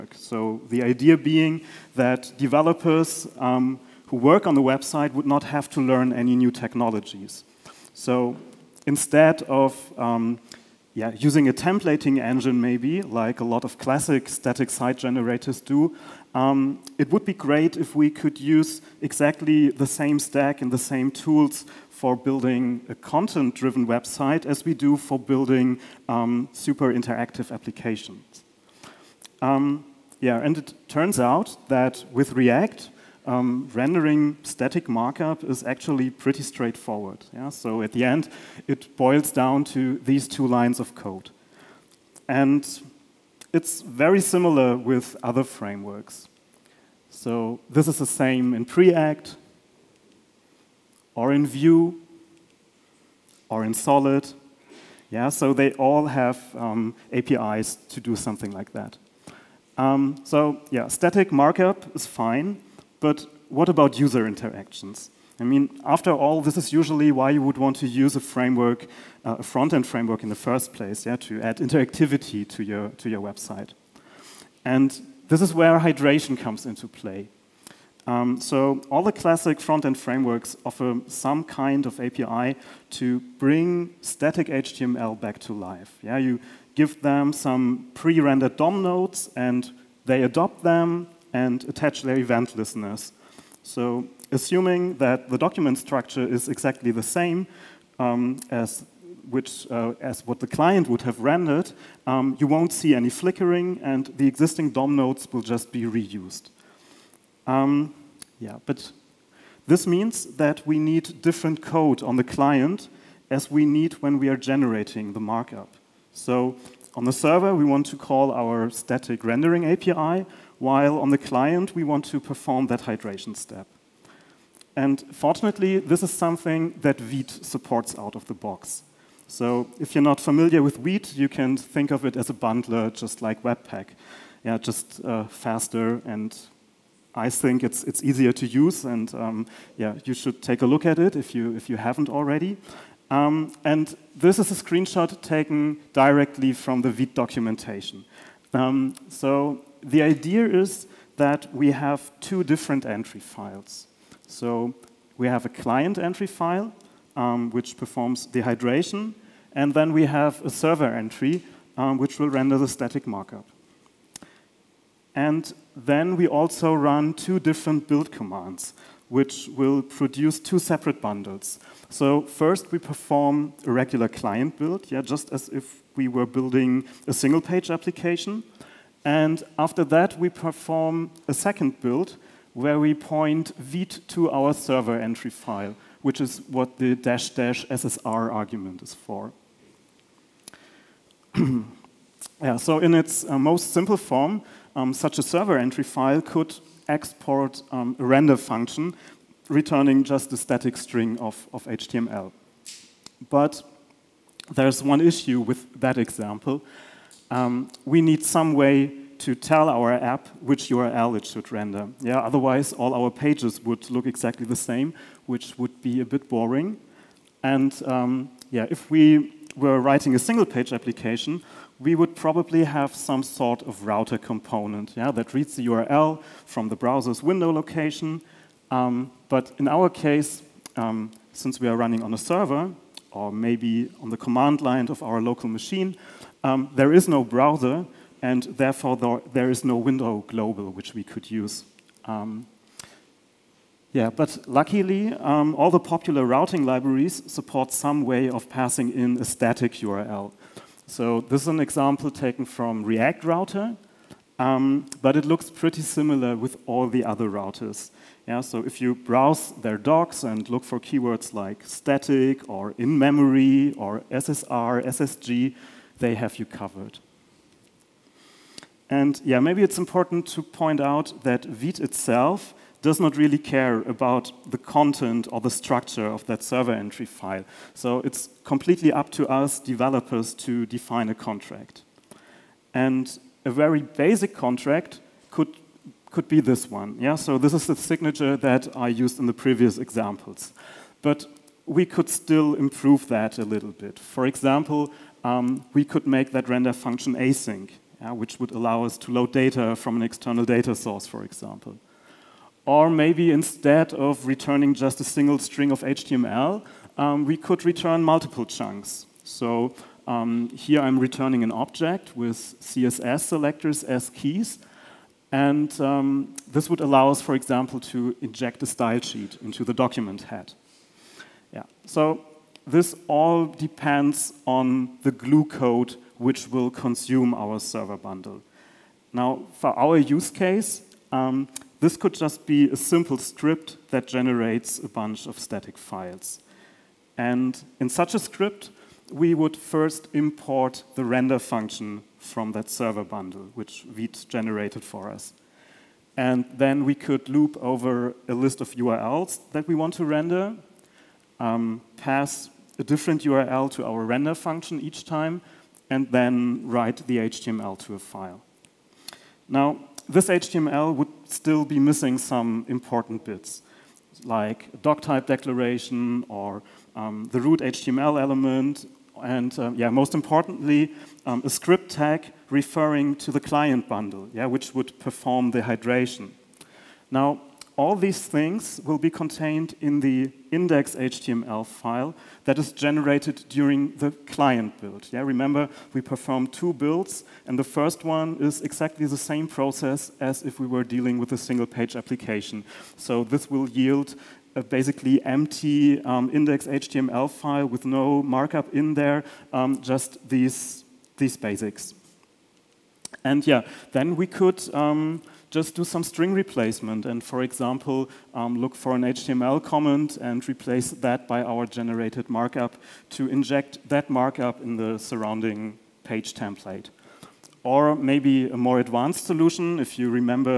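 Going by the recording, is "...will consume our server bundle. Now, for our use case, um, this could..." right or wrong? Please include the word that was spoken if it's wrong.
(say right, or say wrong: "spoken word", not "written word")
right.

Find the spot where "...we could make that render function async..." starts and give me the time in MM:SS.
04:55.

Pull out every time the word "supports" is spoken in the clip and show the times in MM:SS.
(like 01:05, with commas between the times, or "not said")
02:07, 04:07.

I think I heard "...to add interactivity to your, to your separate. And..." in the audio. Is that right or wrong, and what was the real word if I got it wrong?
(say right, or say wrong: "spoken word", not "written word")
wrong: "website", not "separate".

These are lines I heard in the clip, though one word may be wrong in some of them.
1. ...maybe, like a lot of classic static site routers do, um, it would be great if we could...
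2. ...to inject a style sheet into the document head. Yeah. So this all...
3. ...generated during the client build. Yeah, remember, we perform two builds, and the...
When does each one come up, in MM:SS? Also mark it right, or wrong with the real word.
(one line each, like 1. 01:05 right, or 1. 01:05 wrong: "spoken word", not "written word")
1. 00:12 wrong: "generators", not "routers"
2. 05:17 right
3. 06:22 right.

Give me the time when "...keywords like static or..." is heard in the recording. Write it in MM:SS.
04:20.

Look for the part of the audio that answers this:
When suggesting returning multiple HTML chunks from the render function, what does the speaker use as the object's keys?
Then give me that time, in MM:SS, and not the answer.
05:12.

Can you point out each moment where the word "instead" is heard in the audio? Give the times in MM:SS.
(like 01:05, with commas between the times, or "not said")
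00:08, 05:03.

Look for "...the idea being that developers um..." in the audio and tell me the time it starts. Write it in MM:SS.
00:00.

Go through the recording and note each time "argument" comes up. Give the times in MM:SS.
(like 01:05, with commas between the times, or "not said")
03:08.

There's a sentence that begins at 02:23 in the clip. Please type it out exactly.
Um, and this is a screenshot taken directly from the Vite documentation.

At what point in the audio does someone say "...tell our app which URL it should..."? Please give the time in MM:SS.
03:29.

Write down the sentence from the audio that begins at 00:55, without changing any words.
Yeah, so they all have um, APIs to do something like that.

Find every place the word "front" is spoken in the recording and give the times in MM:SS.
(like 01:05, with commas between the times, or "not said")
01:09, 01:19.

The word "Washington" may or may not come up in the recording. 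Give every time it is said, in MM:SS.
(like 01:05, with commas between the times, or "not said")
not said.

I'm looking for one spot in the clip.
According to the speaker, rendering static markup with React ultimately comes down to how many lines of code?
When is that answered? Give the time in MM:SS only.
00:40.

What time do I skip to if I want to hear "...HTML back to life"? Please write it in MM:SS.
01:24.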